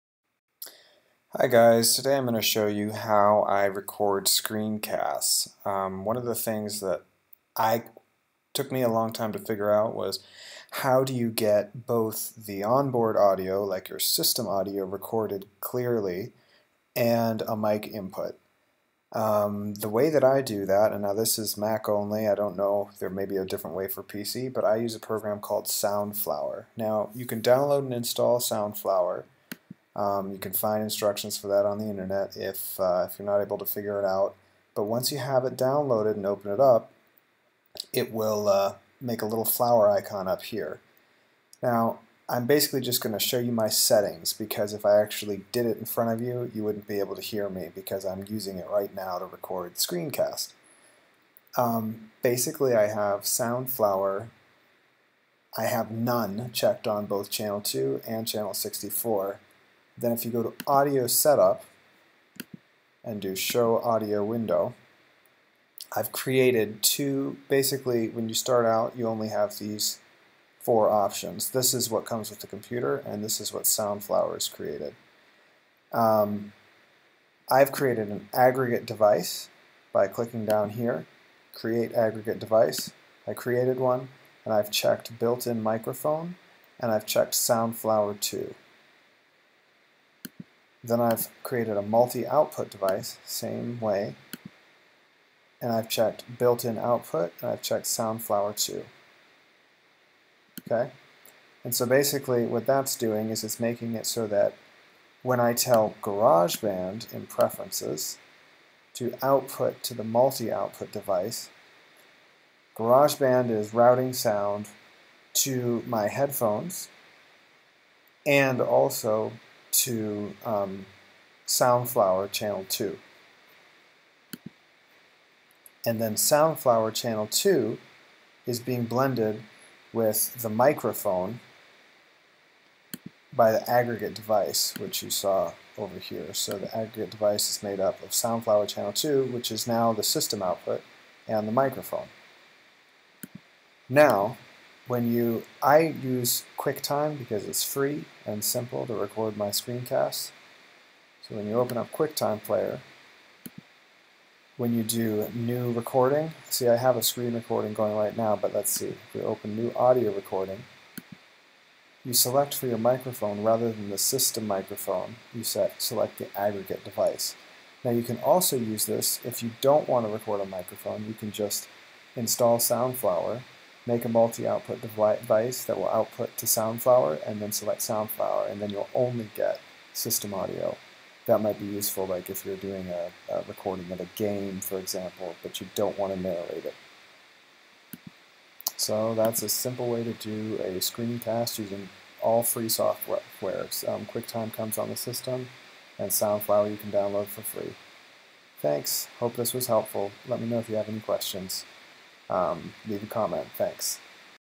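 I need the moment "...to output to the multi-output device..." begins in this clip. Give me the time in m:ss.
1:48.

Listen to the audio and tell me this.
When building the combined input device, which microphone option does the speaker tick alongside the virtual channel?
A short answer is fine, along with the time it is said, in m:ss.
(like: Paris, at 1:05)
built-in microphone, at 1:25.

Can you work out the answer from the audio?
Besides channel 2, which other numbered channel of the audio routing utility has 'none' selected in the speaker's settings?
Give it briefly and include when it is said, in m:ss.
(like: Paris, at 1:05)
64, at 0:58.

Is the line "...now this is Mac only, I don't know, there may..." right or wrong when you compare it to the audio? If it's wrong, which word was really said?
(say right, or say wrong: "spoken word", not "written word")
right.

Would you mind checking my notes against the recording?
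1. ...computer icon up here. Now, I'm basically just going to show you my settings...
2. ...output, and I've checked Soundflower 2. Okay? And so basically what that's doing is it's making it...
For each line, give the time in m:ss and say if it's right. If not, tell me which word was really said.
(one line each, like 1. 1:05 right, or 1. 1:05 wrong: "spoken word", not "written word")
1. 0:39 wrong: "flower", not "computer"
2. 1:36 right.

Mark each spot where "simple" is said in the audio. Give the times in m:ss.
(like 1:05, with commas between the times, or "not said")
2:28, 3:09.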